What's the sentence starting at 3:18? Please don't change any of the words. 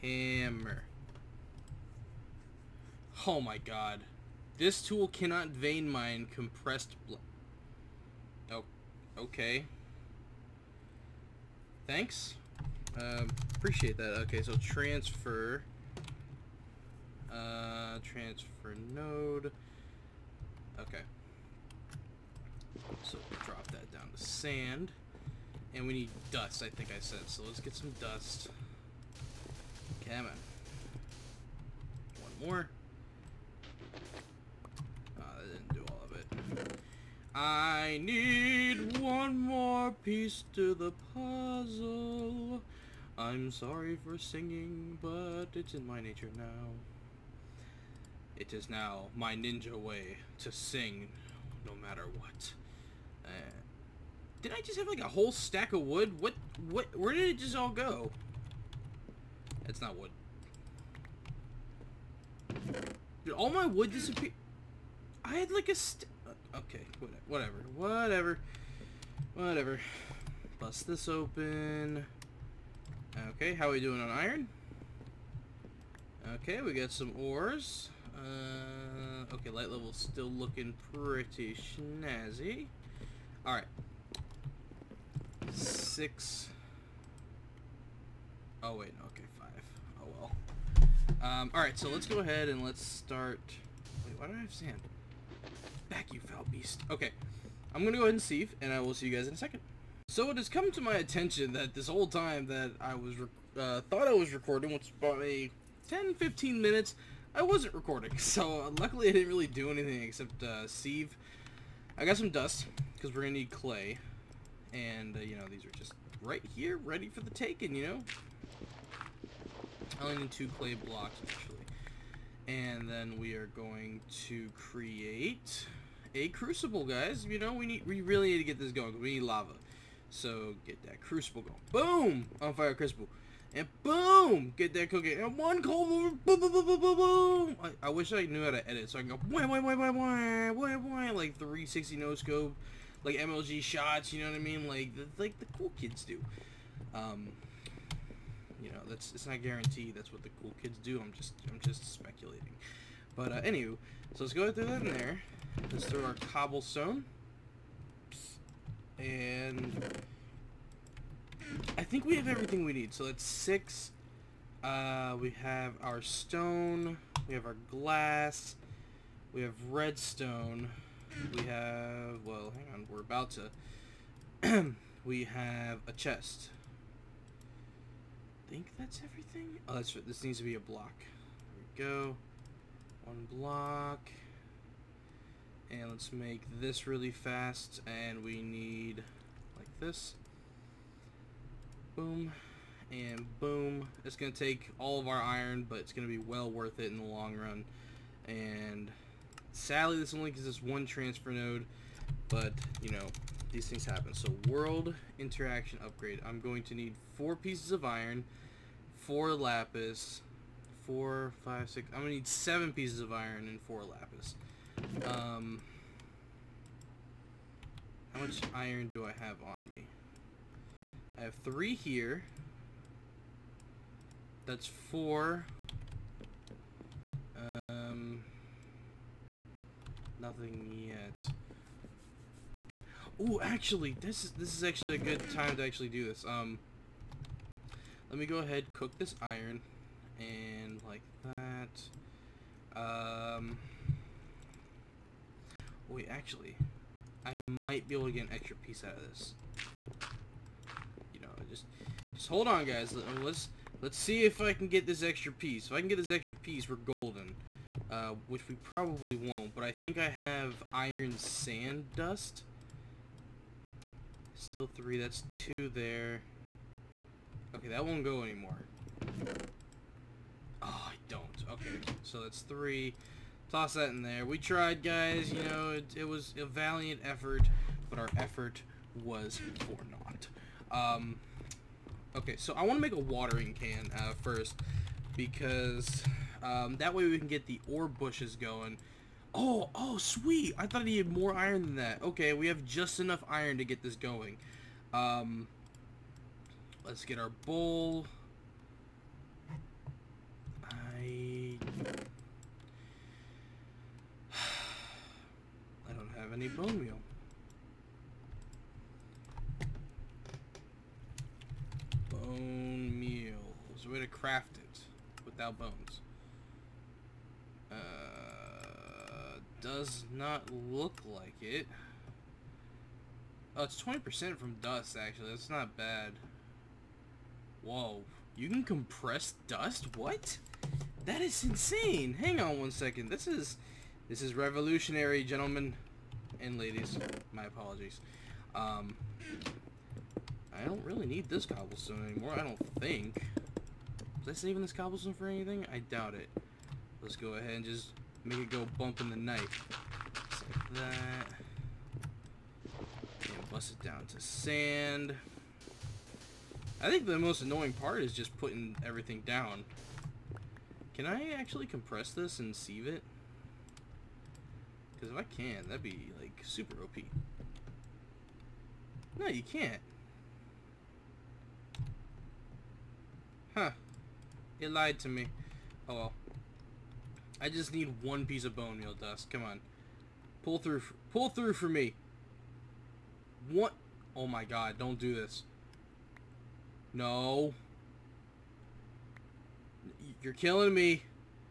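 And sadly, this only gives us one transfer node.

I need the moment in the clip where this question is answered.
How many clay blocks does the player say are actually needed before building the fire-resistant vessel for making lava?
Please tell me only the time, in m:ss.
2:00.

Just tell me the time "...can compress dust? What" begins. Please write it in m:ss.
5:28.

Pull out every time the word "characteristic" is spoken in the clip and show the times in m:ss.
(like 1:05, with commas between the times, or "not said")
not said.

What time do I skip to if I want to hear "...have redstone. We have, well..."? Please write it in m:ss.
2:49.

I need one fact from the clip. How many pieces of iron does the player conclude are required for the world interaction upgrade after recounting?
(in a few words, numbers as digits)
7.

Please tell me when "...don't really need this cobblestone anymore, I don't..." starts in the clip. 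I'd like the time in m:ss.
5:40.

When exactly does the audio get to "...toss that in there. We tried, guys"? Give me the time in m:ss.
4:33.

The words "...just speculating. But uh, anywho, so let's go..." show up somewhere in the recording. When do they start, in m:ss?
2:31.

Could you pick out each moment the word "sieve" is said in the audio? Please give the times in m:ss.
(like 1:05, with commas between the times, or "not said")
1:38, 1:50, 6:02.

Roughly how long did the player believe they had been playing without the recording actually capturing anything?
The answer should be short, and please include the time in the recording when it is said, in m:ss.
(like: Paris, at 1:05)
10-15 minutes, at 1:45.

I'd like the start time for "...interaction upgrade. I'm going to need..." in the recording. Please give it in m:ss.
3:25.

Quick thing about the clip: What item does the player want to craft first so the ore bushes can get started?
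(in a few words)
watering can.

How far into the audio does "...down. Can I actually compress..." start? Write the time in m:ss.
5:59.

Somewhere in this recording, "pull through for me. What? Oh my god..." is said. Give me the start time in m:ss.
6:21.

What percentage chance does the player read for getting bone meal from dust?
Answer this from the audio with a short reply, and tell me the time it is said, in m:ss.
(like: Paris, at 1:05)
20%, at 5:23.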